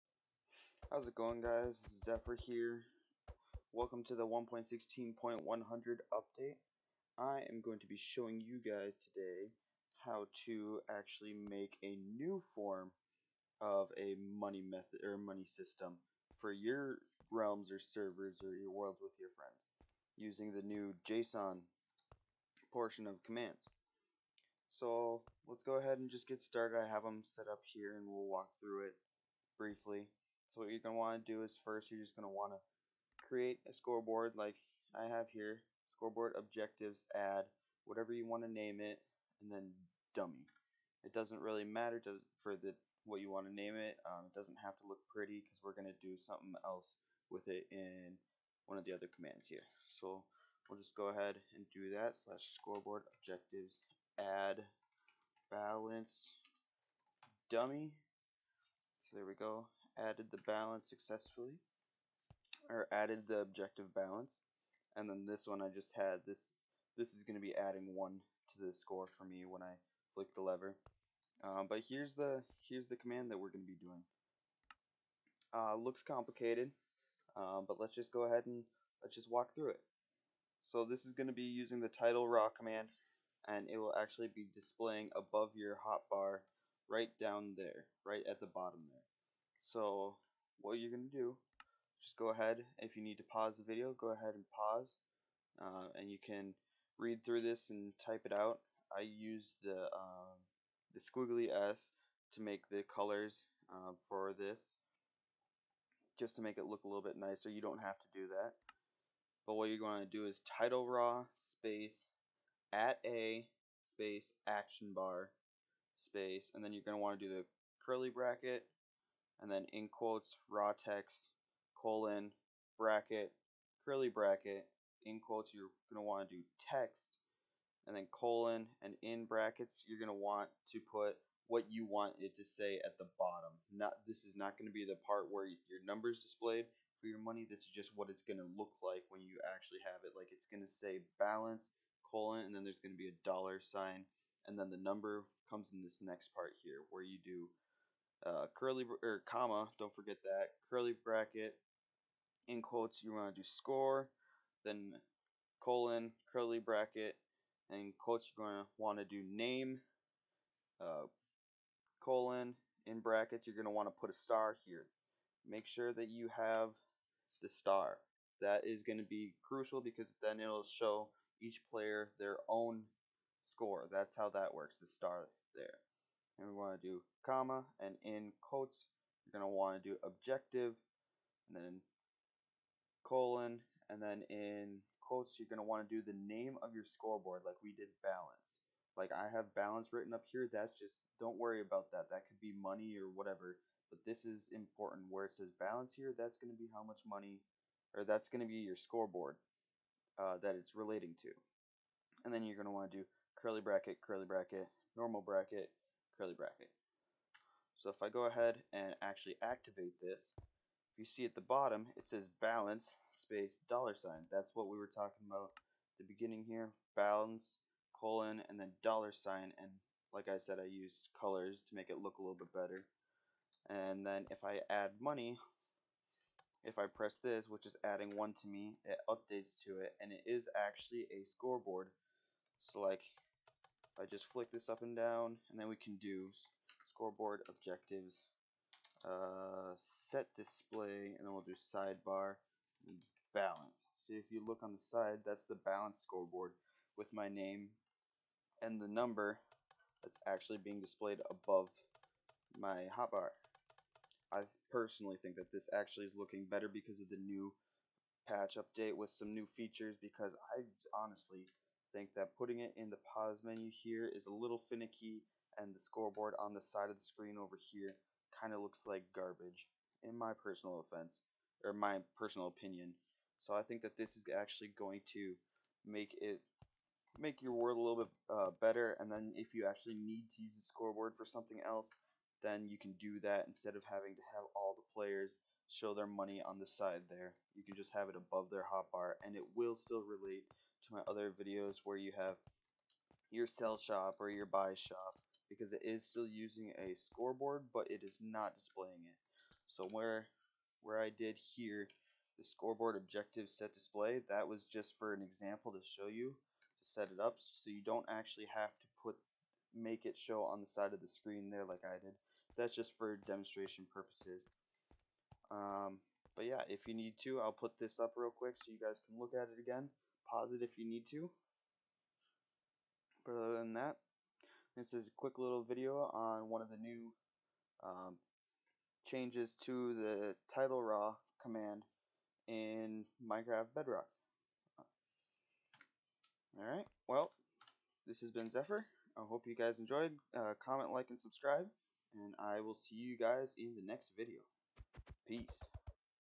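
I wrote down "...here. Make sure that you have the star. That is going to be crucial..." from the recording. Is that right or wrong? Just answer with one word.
right.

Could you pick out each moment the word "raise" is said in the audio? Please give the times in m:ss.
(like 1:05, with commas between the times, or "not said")
not said.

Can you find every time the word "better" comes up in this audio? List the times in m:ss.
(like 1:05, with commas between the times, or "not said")
3:42, 4:16, 4:38.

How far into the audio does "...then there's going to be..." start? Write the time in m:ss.
2:22.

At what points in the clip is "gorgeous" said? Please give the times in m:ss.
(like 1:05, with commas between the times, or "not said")
not said.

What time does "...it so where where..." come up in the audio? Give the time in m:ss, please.
4:59.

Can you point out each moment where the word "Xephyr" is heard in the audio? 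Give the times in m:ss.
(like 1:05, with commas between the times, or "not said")
0:02, 5:38.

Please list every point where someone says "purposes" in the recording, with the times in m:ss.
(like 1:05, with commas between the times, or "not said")
5:13.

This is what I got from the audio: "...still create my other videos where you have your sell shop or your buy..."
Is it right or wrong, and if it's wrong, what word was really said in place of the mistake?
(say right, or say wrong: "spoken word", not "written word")
wrong: "relate", not "create".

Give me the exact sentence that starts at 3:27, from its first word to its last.
So if I go ahead and actually activate this, if you see at the bottom, it says balance space dollar sign.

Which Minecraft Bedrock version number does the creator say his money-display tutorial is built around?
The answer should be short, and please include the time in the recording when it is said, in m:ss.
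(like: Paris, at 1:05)
1.16.100, at 0:04.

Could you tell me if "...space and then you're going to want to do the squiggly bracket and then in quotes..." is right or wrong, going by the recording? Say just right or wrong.
wrong.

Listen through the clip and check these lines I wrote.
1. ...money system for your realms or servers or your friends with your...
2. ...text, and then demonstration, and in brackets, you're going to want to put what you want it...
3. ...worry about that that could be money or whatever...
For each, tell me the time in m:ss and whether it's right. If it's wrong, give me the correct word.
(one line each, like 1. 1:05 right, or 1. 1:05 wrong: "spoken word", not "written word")
1. 0:15 wrong: "worlds", not "friends"
2. 2:06 wrong: "colon", not "demonstration"
3. 3:11 right.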